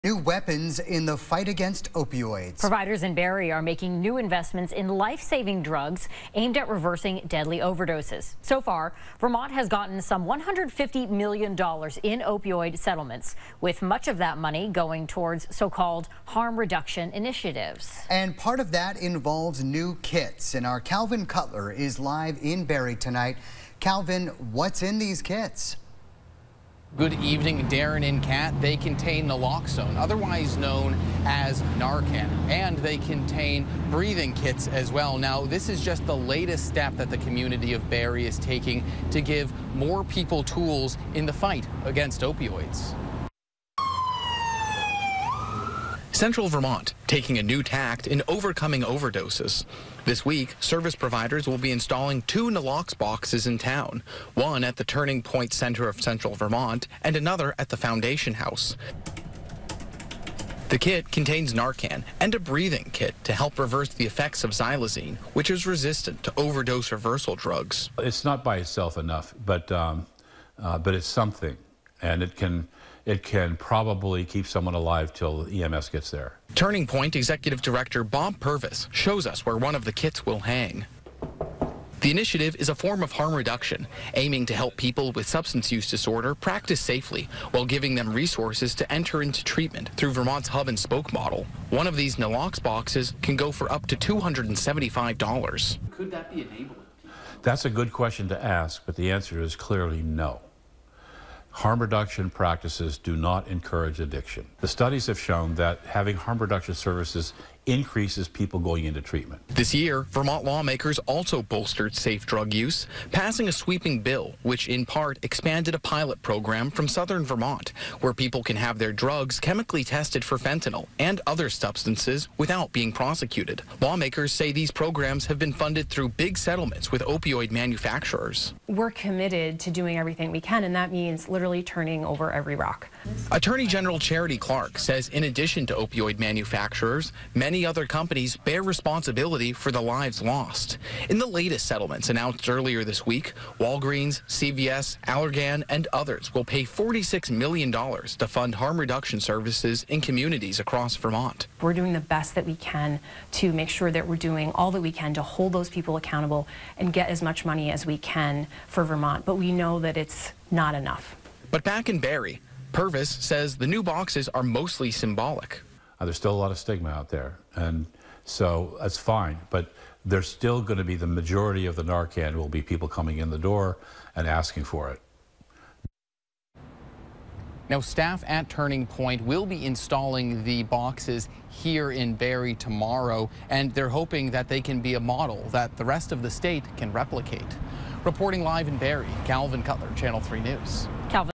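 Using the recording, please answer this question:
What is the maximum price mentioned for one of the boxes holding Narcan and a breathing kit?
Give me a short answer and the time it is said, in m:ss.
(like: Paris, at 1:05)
$275, at 1:33.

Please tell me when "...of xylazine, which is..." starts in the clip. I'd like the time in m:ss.
1:04.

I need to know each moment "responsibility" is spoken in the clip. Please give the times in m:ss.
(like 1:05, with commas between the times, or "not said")
2:18.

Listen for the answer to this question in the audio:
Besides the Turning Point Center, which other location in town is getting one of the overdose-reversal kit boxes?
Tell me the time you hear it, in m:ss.
0:57.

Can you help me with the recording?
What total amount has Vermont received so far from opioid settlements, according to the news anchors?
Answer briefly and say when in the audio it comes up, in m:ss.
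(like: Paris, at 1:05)
$150 million, at 0:10.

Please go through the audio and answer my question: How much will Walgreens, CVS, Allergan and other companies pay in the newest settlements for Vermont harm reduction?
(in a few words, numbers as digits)
$46 million.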